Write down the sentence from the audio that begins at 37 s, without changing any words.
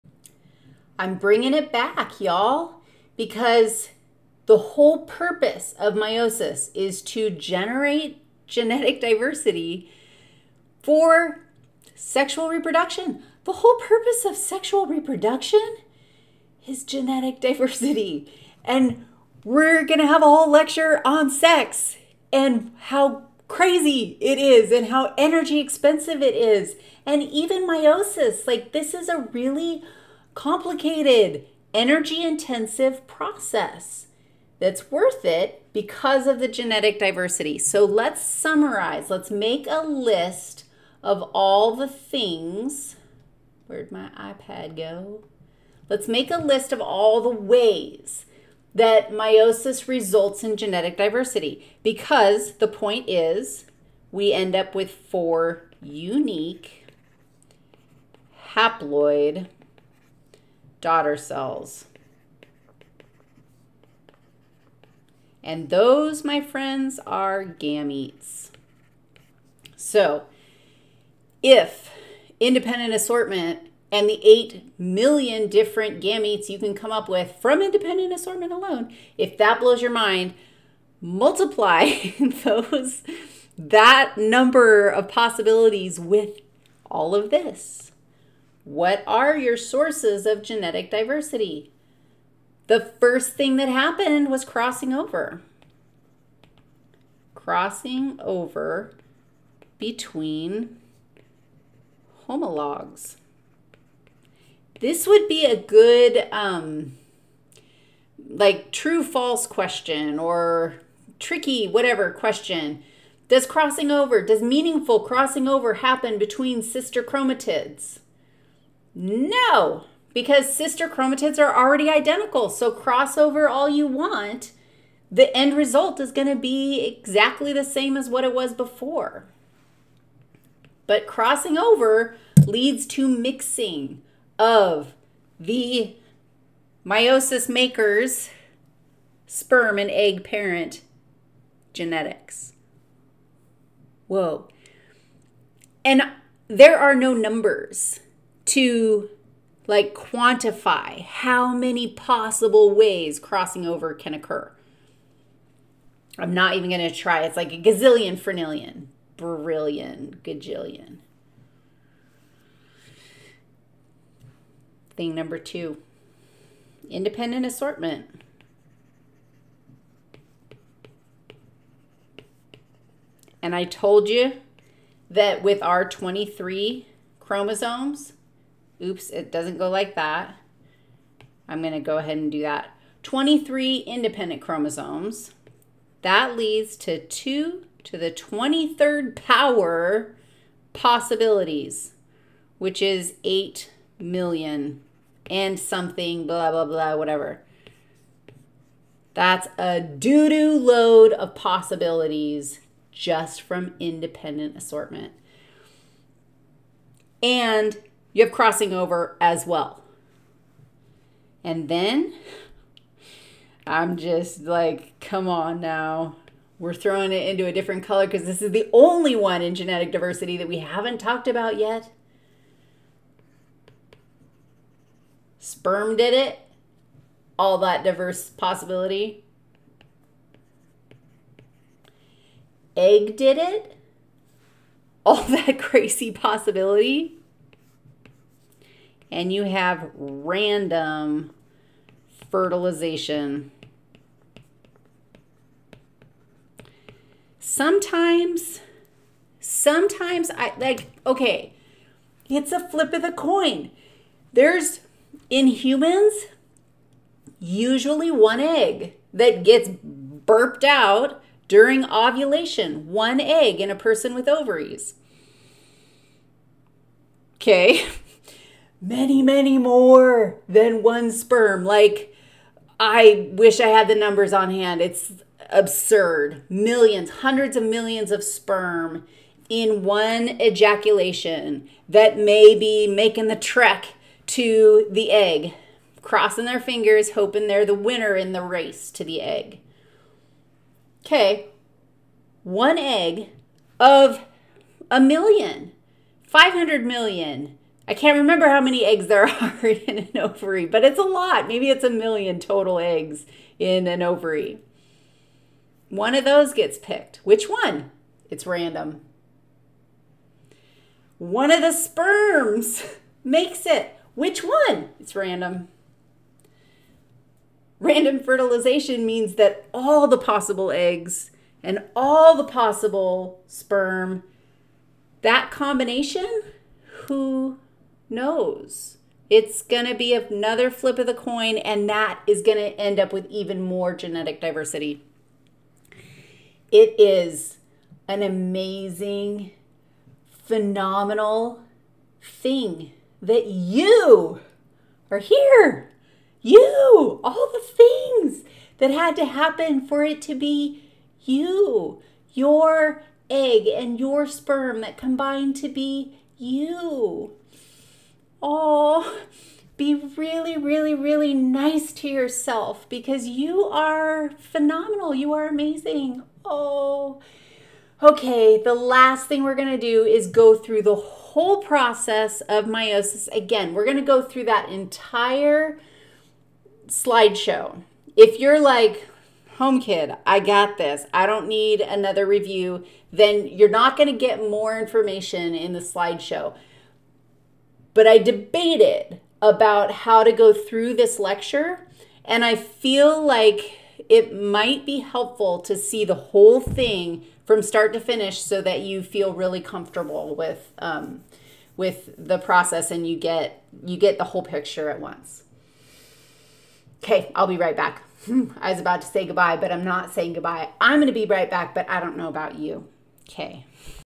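So let's summarize, let's make a list of all the things.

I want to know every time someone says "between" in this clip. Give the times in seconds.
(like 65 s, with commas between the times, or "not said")
99 s, 116 s.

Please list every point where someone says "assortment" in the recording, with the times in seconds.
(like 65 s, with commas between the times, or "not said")
72 s, 78 s, 167 s, 204 s.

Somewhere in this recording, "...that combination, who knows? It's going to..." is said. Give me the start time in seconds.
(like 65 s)
325 s.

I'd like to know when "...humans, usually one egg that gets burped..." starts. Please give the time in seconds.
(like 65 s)
255 s.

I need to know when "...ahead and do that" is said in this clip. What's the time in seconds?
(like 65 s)
181 s.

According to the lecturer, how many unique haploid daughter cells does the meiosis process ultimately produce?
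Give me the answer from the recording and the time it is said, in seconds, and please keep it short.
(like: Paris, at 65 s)
4, at 54 s.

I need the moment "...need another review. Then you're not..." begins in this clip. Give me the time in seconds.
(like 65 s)
381 s.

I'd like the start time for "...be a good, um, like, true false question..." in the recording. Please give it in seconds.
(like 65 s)
105 s.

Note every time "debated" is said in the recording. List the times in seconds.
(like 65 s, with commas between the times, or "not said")
388 s.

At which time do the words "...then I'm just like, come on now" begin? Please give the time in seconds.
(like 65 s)
211 s.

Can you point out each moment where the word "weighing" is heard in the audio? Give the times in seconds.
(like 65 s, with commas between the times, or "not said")
not said.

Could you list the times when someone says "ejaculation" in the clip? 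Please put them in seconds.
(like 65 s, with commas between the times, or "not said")
280 s.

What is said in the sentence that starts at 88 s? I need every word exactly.
What are your sources of genetic diversity?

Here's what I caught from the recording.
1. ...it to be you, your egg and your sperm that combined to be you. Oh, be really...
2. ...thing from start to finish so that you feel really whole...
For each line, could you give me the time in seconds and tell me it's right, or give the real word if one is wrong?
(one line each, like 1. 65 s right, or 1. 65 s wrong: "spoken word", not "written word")
1. 350 s right
2. 396 s wrong: "comfortable", not "whole".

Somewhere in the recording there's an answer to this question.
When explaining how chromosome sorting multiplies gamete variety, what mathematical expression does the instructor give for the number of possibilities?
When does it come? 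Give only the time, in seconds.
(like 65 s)
187 s.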